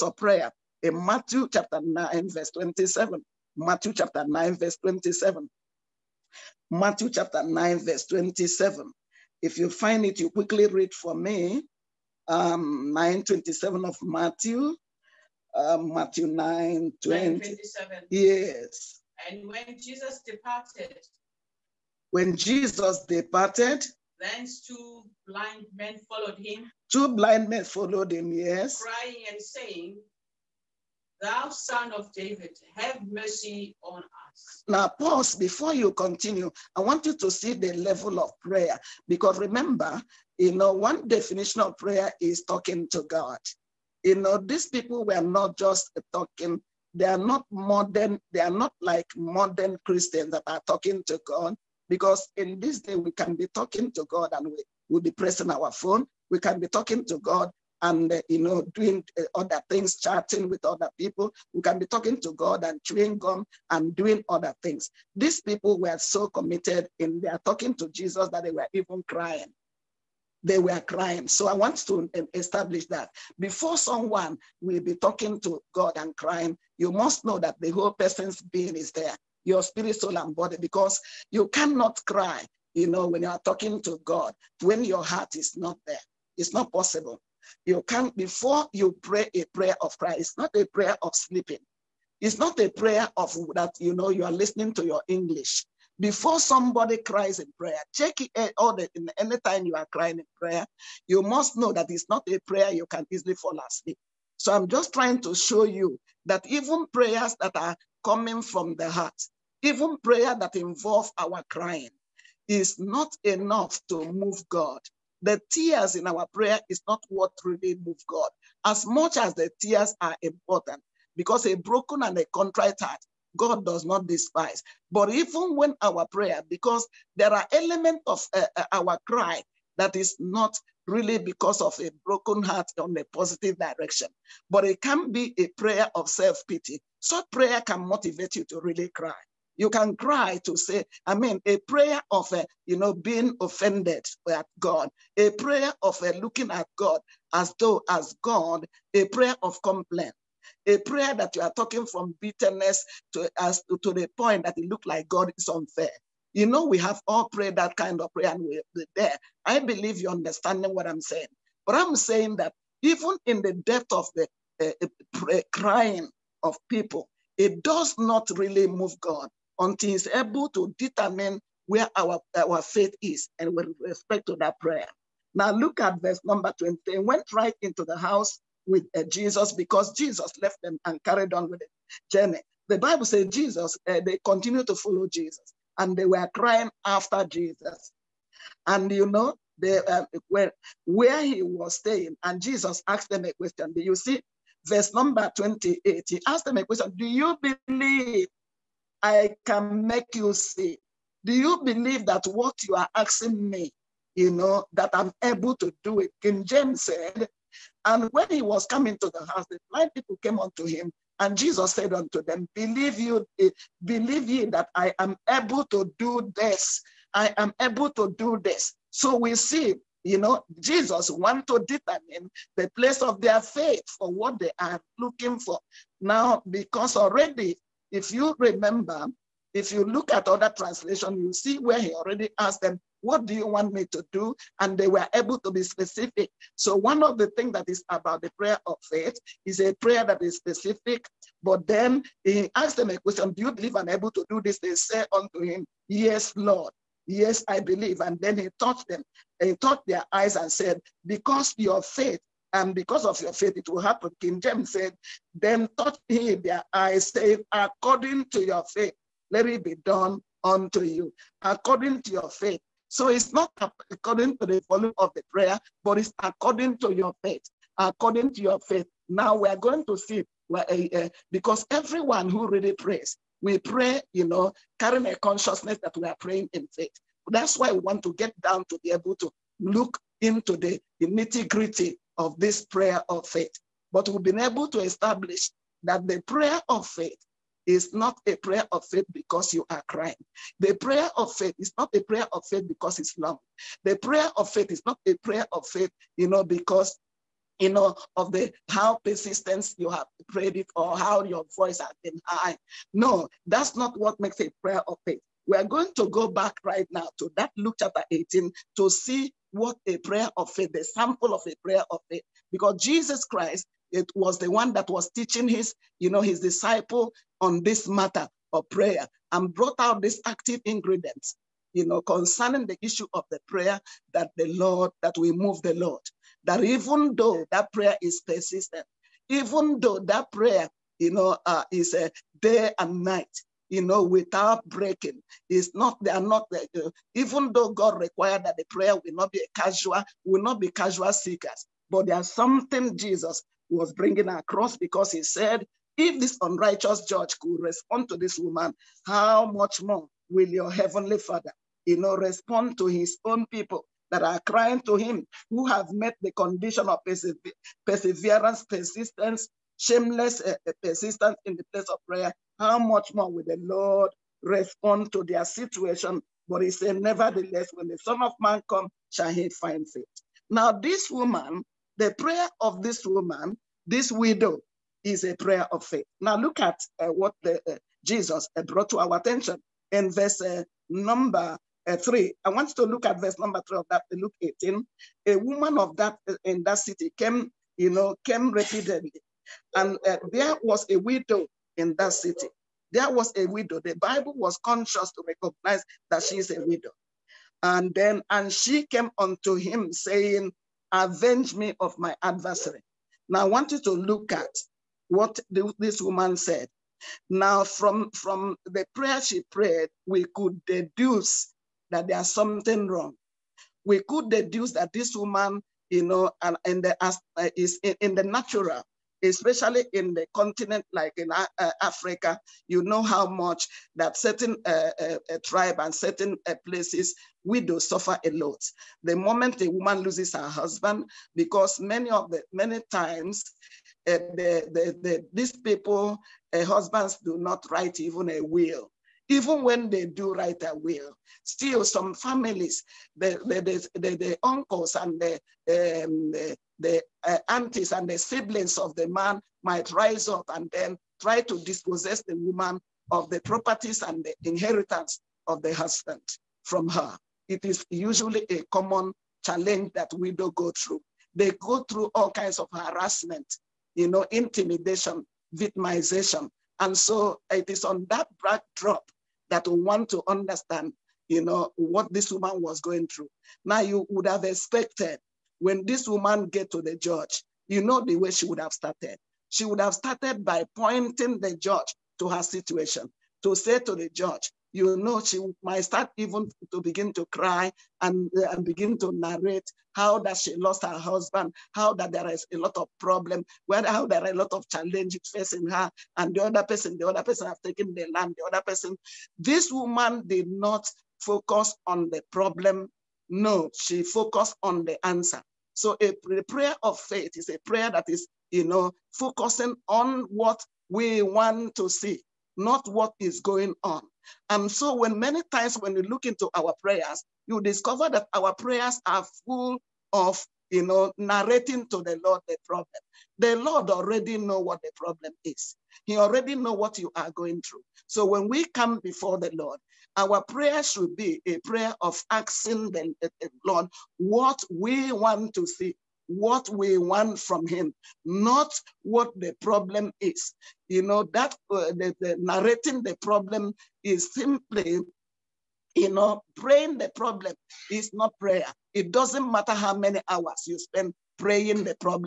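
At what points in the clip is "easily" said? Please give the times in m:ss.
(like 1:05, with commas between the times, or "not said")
1:43.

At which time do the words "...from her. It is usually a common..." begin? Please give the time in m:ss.
7:36.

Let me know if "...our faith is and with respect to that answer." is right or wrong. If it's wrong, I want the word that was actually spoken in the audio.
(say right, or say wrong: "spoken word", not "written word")
wrong: "prayer", not "answer".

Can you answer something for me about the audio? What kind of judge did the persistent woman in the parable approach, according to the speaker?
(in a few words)
unrighteous judge.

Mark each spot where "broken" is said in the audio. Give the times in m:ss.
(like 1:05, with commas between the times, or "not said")
2:01, 2:12.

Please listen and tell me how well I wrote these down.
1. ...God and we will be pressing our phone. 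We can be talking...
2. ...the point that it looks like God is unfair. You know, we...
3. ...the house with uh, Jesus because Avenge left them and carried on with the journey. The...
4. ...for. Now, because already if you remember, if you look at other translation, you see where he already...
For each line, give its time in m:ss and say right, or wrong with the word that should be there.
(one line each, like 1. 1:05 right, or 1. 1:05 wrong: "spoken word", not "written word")
1. 0:54 right
2. 2:33 right
3. 2:57 wrong: "Jesus", not "Avenge"
4. 3:45 right.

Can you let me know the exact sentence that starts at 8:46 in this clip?
He already know what you are going through.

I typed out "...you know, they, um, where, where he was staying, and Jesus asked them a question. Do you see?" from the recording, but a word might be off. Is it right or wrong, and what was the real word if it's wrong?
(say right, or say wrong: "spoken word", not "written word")
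right.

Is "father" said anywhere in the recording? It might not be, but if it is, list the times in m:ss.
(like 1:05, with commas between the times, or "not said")
5:51.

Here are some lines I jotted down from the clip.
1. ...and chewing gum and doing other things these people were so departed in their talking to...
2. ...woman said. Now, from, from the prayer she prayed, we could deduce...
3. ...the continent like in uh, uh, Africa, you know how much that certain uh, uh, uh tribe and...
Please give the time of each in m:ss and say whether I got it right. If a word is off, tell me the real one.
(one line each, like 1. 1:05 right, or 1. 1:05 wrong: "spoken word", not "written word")
1. 1:02 wrong: "committed", not "departed"
2. 6:45 right
3. 7:00 right.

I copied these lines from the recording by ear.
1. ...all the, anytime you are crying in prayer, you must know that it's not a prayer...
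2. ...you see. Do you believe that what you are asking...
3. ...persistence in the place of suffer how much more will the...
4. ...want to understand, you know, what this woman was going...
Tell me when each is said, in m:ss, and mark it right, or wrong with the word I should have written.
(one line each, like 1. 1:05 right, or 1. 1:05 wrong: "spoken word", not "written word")
1. 1:38 right
2. 3:20 right
3. 6:00 wrong: "prayer", not "suffer"
4. 7:49 right.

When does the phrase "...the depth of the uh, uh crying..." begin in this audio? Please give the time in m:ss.
2:43.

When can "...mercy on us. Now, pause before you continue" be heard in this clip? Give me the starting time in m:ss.
0:33.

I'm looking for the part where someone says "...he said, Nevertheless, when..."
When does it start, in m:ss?
6:06.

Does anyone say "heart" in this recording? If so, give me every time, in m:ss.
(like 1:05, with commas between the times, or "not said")
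1:25, 1:48, 2:02, 2:12.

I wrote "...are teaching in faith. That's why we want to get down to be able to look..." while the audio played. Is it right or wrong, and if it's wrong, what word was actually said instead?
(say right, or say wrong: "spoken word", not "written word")
wrong: "praying", not "teaching".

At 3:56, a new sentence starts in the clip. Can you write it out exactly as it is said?
So one of the things that is about the prayer of faith is a prayer that is specific.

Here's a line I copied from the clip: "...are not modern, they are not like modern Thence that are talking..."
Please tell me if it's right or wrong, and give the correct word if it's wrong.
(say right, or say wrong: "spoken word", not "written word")
wrong: "Christians", not "Thence".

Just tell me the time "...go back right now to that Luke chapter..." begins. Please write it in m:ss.
5:06.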